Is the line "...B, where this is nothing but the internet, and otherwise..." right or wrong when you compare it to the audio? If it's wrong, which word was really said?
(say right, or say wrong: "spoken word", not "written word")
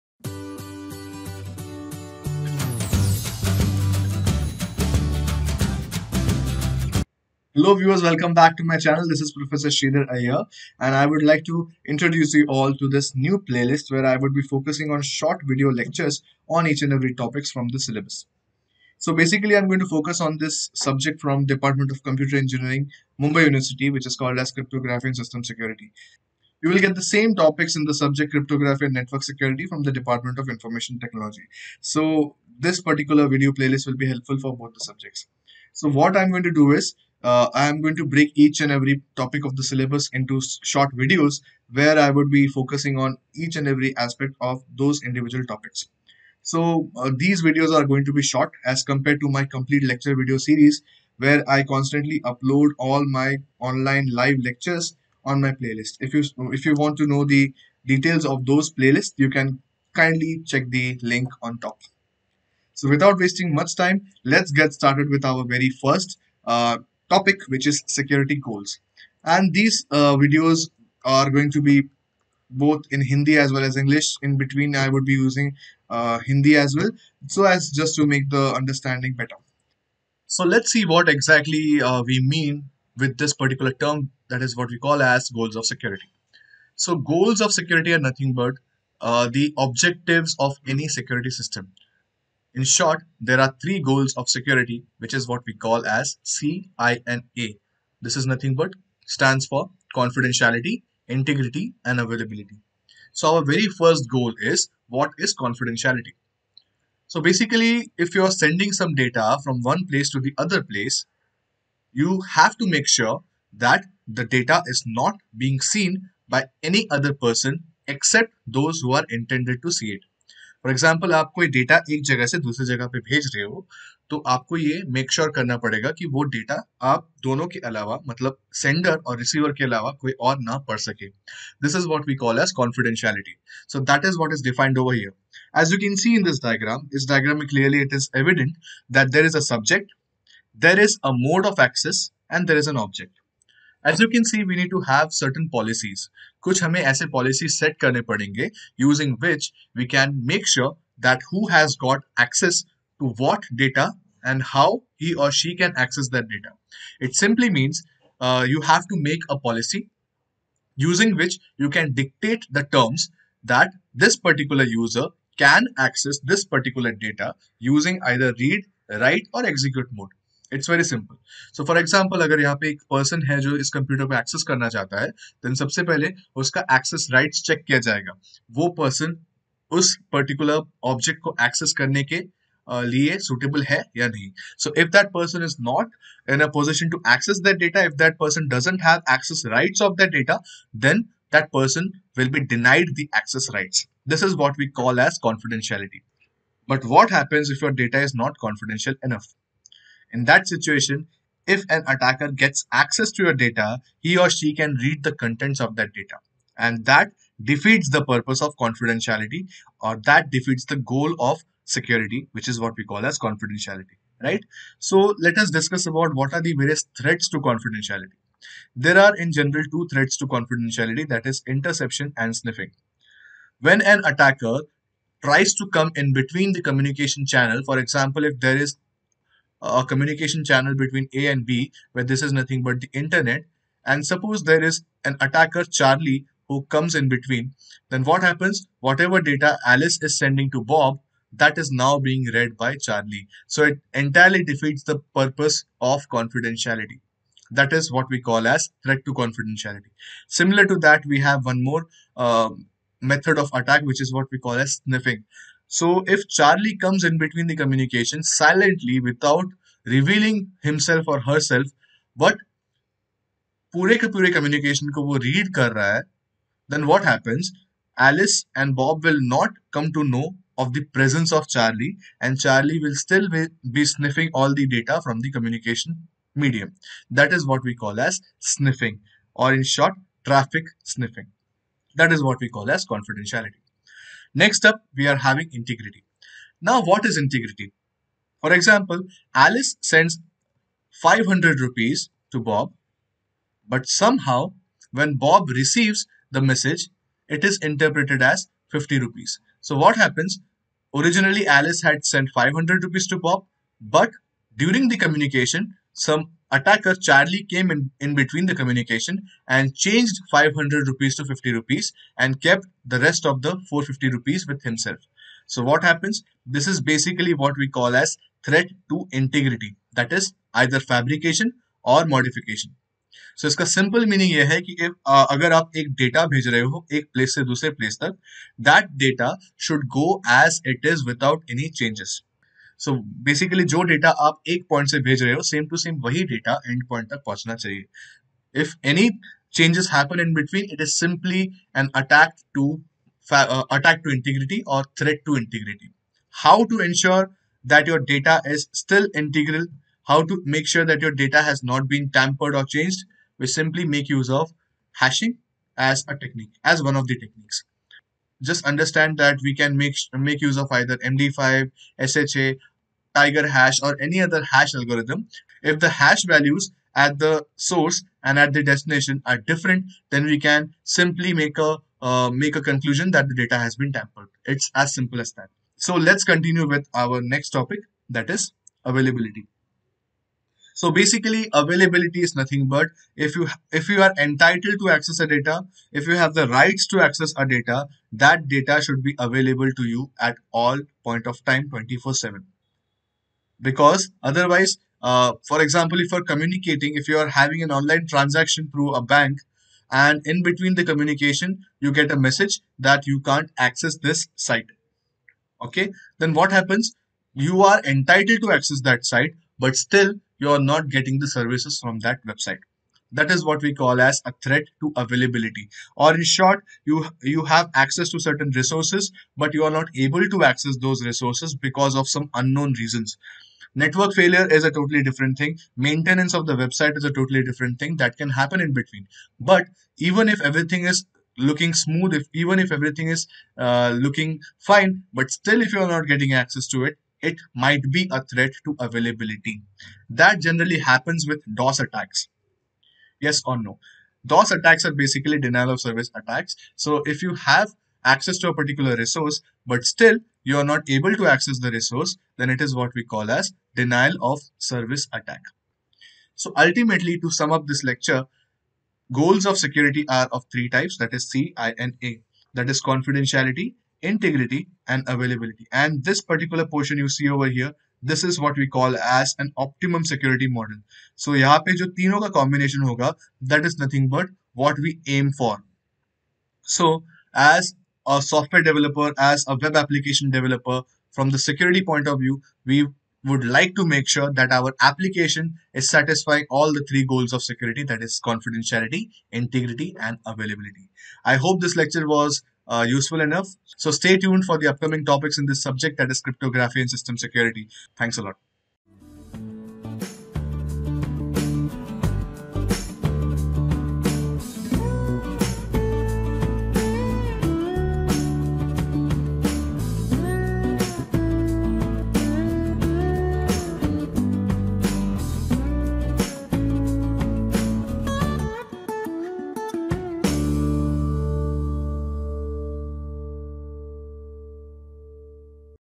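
wrong: "suppose", not "otherwise".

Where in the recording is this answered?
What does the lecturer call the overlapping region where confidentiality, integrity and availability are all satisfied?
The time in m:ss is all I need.
7:49.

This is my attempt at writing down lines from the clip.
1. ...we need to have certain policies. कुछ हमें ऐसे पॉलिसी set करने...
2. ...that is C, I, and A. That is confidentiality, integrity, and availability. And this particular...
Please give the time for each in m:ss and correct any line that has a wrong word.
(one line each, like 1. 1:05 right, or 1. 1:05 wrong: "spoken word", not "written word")
1. 2:24 right
2. 7:40 right.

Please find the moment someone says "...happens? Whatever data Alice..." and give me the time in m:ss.
3:58.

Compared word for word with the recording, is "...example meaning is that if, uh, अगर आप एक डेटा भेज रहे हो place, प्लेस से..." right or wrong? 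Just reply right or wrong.
wrong.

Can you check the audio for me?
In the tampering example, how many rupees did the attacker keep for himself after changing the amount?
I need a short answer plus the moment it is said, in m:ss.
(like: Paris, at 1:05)
450 rupees, at 5:13.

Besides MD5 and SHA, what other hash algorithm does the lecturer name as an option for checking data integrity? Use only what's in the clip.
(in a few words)
Tiger hash.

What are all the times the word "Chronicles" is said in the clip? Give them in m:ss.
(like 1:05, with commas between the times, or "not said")
not said.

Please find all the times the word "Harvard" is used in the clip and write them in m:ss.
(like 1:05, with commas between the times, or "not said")
not said.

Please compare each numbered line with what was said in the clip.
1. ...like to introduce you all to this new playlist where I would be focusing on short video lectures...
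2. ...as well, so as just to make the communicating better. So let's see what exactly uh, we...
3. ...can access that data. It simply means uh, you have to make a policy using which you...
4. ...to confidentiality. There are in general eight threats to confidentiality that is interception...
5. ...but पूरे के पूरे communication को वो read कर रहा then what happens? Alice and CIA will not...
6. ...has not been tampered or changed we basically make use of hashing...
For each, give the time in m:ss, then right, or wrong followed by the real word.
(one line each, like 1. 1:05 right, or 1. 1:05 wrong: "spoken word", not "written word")
1. 0:11 right
2. 1:16 wrong: "understanding", not "communicating"
3. 2:35 right
4. 3:37 wrong: "two", not "eight"
5. 4:22 wrong: "Bob", not "CIA"
6. 5:51 wrong: "simply", not "basically".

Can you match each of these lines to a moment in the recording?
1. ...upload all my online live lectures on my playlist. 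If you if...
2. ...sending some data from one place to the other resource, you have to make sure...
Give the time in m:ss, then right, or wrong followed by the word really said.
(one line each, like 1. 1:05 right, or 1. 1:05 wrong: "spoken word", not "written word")
1. 0:52 right
2. 1:48 wrong: "place", not "resource".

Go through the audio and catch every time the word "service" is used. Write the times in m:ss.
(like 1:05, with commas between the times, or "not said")
6:51, 7:25, 7:34.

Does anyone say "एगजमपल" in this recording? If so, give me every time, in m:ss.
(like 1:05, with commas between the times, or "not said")
2:00, 2:51.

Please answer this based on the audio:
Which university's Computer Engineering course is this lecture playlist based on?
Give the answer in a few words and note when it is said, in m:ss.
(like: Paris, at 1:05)
Mumbai University, at 0:23.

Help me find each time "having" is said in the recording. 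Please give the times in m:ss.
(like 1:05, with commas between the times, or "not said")
4:45, 6:37.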